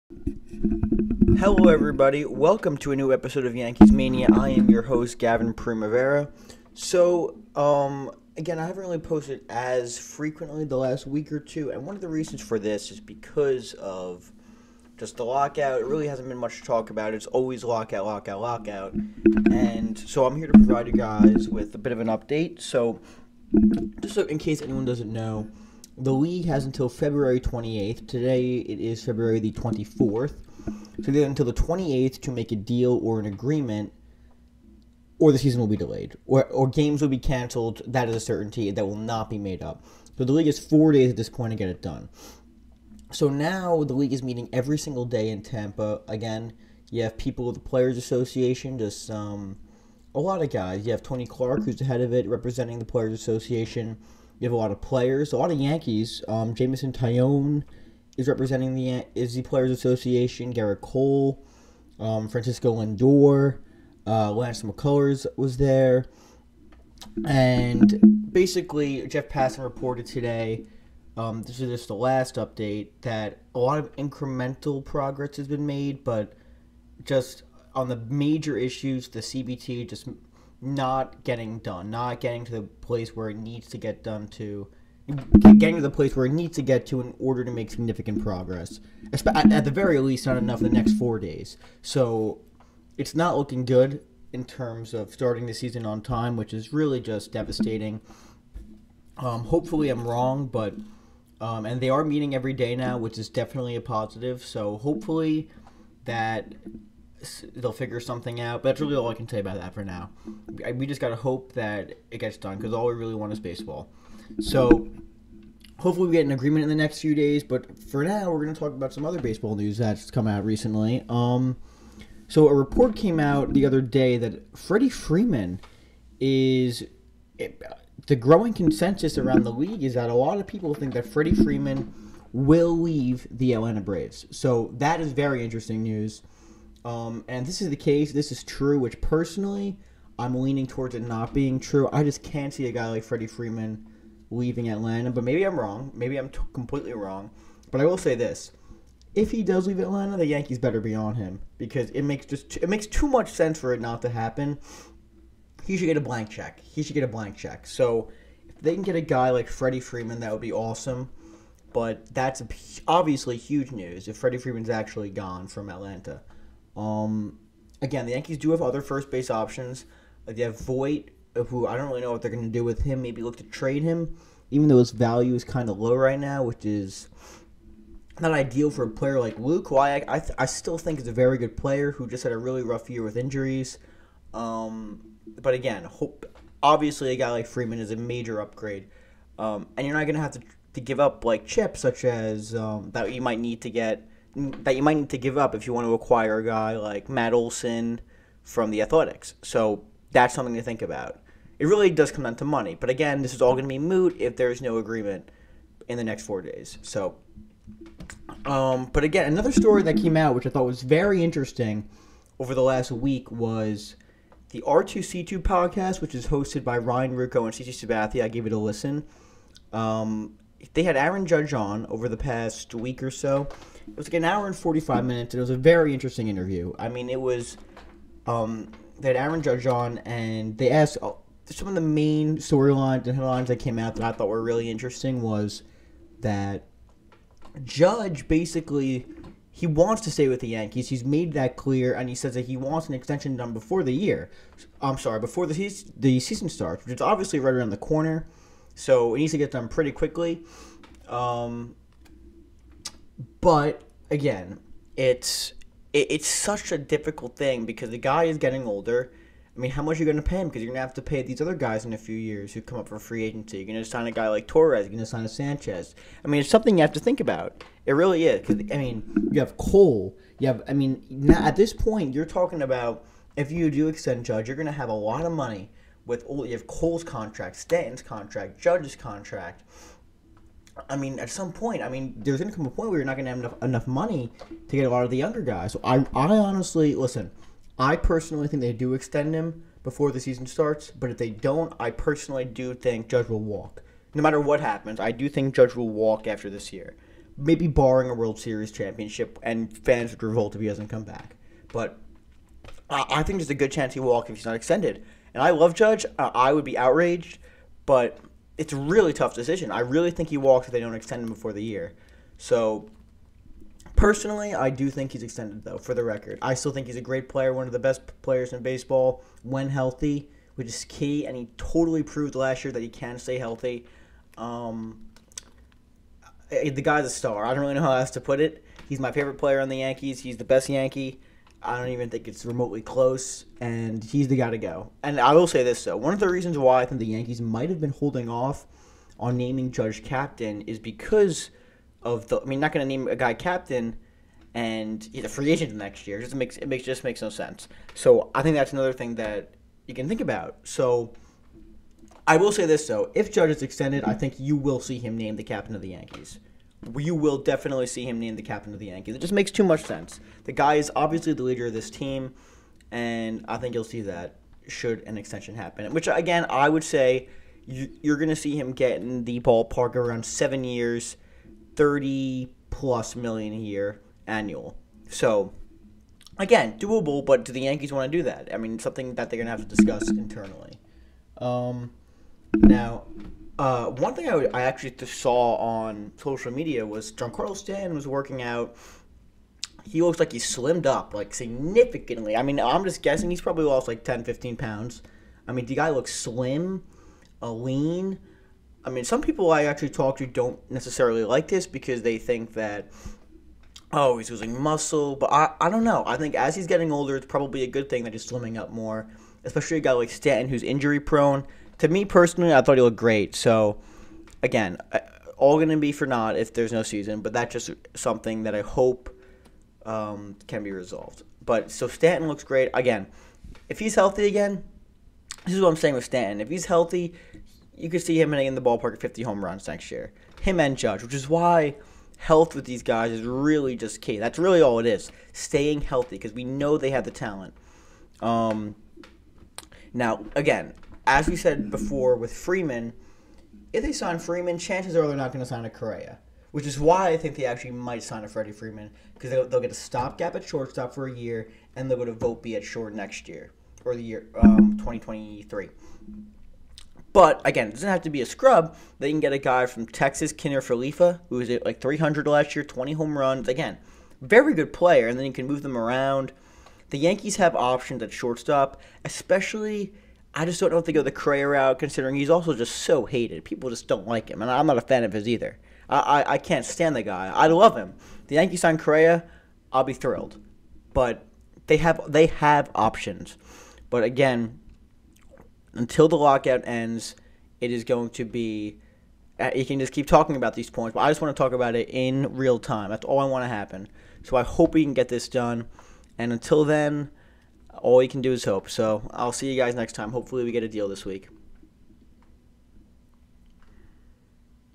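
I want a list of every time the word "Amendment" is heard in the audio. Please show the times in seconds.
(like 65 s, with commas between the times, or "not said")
not said.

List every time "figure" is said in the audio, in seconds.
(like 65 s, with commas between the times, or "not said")
107 s.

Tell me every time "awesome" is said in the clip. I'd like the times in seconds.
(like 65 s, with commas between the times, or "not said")
160 s.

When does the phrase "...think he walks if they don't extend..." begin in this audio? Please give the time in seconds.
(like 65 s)
310 s.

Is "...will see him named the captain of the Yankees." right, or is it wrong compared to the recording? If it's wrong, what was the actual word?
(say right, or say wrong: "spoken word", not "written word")
right.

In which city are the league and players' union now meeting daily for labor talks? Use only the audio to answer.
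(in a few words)
Tampa.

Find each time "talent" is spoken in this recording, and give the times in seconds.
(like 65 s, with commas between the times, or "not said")
437 s.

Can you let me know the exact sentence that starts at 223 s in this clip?
It was like an hour and 45 minutes, and it was a very interesting interview.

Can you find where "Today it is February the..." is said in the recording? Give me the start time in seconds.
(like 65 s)
28 s.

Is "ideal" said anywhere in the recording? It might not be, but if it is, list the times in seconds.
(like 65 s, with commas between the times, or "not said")
178 s.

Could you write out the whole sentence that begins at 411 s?
To me personally, I thought he looked great.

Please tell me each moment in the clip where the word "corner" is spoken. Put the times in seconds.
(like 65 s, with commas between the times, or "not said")
247 s.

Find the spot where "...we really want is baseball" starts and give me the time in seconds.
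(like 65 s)
112 s.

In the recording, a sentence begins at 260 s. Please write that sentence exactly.
Because you're going to have to pay these other guys in a few years who come up for free agency.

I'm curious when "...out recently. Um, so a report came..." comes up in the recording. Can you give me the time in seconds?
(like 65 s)
120 s.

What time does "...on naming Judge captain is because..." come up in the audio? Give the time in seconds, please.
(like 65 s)
339 s.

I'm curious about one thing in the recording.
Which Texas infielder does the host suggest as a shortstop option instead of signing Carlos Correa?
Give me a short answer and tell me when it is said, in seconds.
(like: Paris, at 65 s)
Kiner-Falefa, at 460 s.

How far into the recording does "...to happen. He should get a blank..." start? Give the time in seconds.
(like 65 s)
154 s.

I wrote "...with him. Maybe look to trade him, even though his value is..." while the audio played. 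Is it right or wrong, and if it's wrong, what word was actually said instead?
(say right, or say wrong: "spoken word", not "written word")
right.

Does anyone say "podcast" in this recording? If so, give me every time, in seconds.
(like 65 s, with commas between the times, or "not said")
215 s.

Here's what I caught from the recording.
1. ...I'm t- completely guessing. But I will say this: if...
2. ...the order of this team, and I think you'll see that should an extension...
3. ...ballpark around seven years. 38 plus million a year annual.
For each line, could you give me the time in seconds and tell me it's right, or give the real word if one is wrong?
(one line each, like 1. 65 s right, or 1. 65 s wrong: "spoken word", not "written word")
1. 146 s wrong: "wrong", not "guessing"
2. 361 s wrong: "leader", not "order"
3. 369 s wrong: "30", not "38".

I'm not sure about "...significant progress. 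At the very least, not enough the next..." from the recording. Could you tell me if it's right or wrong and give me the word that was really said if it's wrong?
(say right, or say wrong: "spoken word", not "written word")
right.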